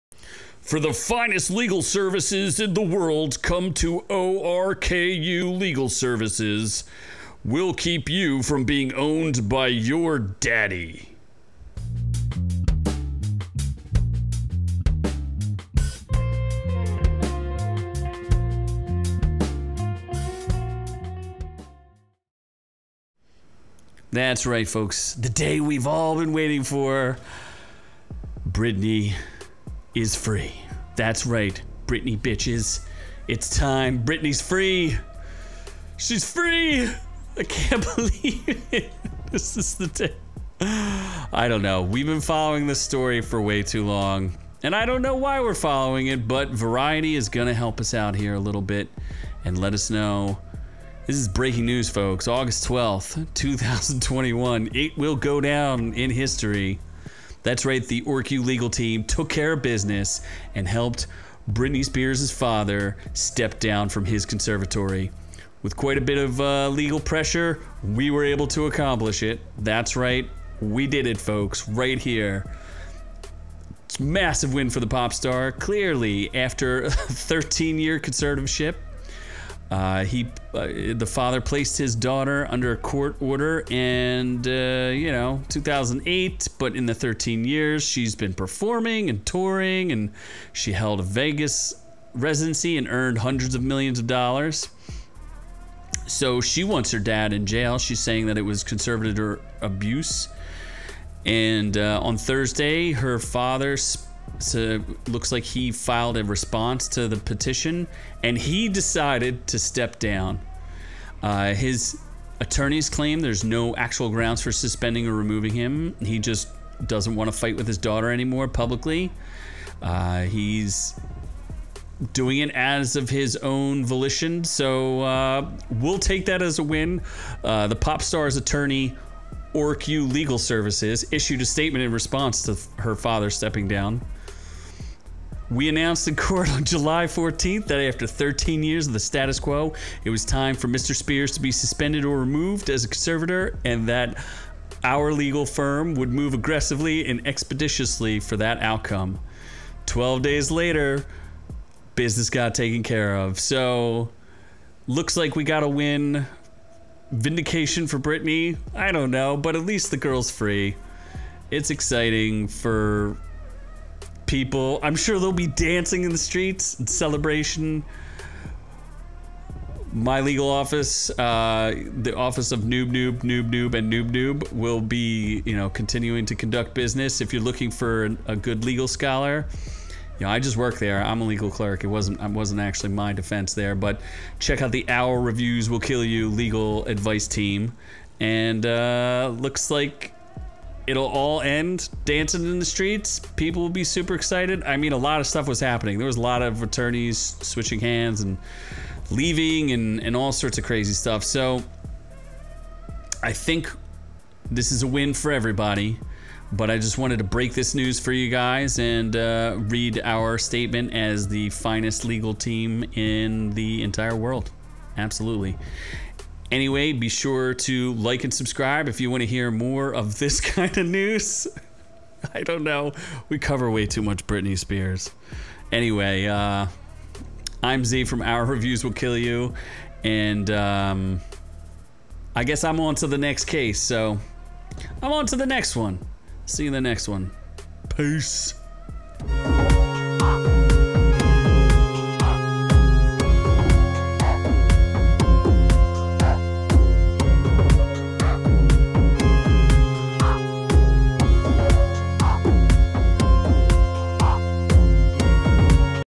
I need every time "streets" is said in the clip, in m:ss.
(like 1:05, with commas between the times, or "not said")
2:46, 3:12.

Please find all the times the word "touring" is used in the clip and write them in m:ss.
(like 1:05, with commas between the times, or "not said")
1:29.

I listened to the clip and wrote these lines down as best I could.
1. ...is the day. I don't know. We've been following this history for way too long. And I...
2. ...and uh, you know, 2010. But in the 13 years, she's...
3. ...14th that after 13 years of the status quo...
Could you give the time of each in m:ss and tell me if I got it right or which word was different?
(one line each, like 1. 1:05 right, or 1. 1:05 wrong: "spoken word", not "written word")
1. 0:39 wrong: "story", not "history"
2. 1:23 wrong: "2008", not "2010"
3. 2:17 right.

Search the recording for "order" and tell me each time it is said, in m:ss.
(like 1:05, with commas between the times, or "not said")
1:23.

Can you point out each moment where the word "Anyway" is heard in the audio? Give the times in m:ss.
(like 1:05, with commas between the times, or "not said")
3:36, 3:45.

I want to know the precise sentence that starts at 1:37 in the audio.
She's saying that it was conservator abuse.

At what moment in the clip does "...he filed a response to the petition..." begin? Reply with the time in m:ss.
1:45.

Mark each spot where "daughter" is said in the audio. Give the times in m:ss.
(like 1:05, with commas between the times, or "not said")
1:21, 1:57.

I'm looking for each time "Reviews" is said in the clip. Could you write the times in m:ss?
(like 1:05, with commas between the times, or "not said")
3:05, 3:48.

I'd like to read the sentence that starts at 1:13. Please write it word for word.
It's massive win for the pop star.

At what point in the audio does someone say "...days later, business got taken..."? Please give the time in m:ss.
2:30.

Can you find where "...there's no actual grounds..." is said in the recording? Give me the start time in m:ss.
1:53.